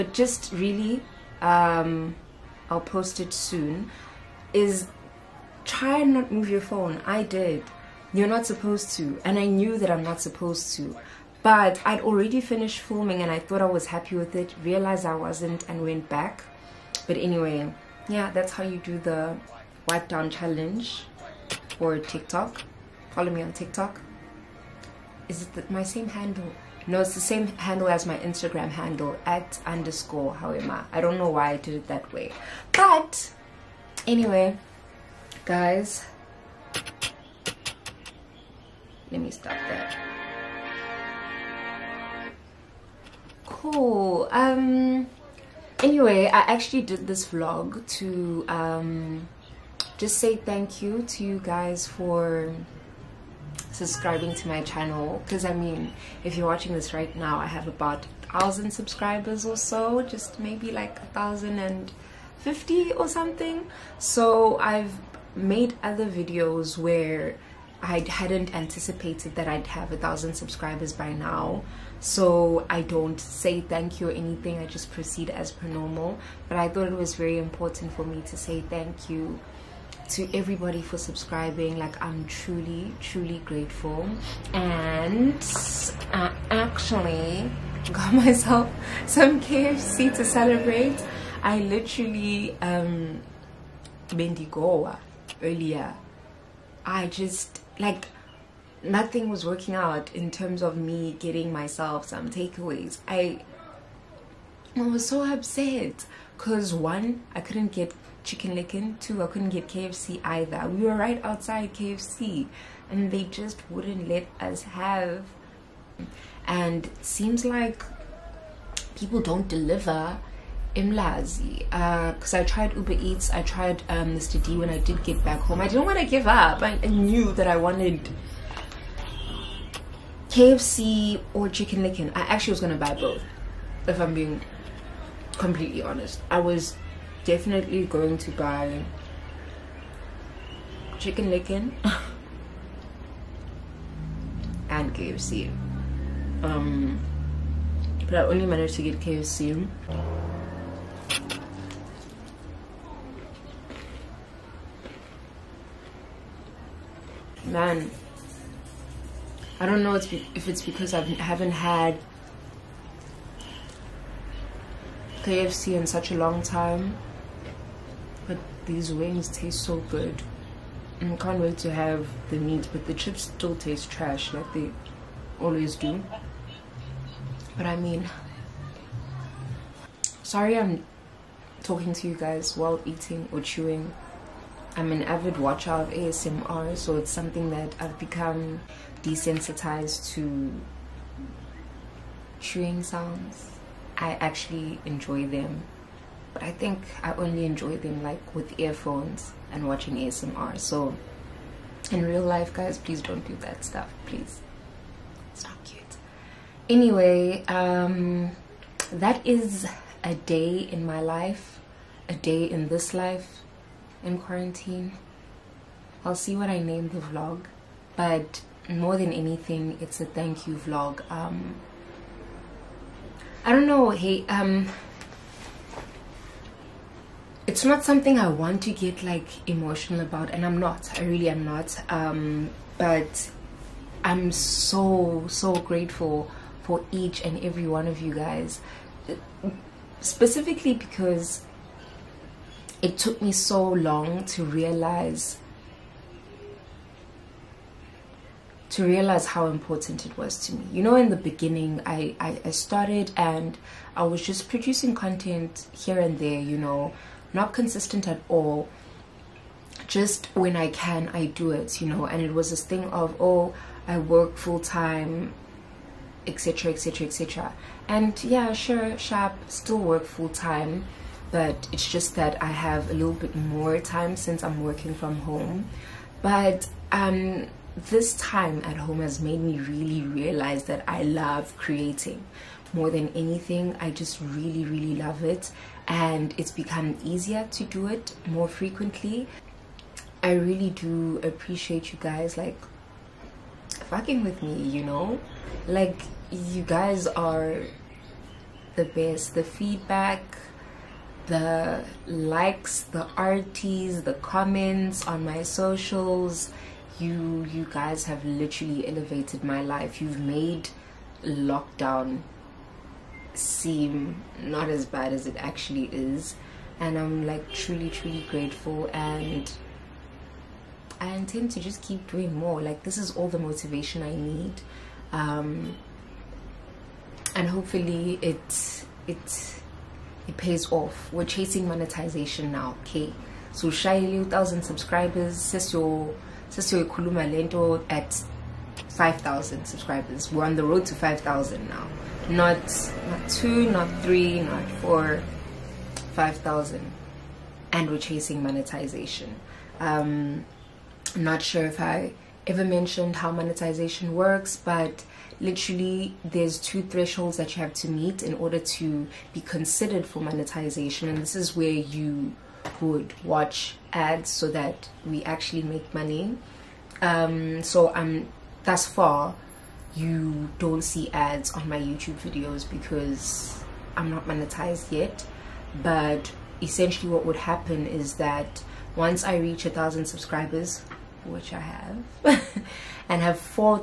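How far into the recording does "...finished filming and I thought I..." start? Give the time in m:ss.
0:12.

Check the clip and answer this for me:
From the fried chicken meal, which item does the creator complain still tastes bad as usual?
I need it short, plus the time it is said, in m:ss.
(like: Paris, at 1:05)
chips, at 2:52.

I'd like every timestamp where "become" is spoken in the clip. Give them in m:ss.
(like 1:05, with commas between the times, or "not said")
3:07, 4:46.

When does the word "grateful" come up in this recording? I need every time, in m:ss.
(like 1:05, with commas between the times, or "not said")
1:23, 3:55, 5:18.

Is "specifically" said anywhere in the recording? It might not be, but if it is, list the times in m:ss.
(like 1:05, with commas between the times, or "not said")
4:00.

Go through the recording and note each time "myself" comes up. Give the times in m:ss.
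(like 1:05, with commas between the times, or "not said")
1:28, 1:41.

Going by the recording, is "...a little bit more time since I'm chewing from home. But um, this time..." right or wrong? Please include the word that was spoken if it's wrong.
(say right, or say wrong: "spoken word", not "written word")
wrong: "working", not "chewing".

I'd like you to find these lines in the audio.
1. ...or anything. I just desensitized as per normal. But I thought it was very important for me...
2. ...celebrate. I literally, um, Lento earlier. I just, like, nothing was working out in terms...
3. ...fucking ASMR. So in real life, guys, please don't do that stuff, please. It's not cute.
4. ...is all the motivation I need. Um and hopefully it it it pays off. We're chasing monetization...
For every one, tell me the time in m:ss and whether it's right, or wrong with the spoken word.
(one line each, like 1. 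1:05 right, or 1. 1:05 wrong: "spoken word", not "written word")
1. 1:14 wrong: "proceed", not "desensitized"
2. 1:30 wrong: "Bendigoa", not "Lento"
3. 3:19 wrong: "watching", not "fucking"
4. 5:22 right.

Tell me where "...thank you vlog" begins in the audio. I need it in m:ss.
3:40.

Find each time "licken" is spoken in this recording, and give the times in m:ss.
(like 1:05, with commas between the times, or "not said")
1:48, 2:11, 2:21.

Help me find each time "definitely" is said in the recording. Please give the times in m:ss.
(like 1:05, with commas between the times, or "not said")
2:17.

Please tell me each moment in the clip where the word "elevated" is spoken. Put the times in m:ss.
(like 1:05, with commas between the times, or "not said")
5:08.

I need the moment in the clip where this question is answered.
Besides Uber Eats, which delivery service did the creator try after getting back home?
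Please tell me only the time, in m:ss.
2:04.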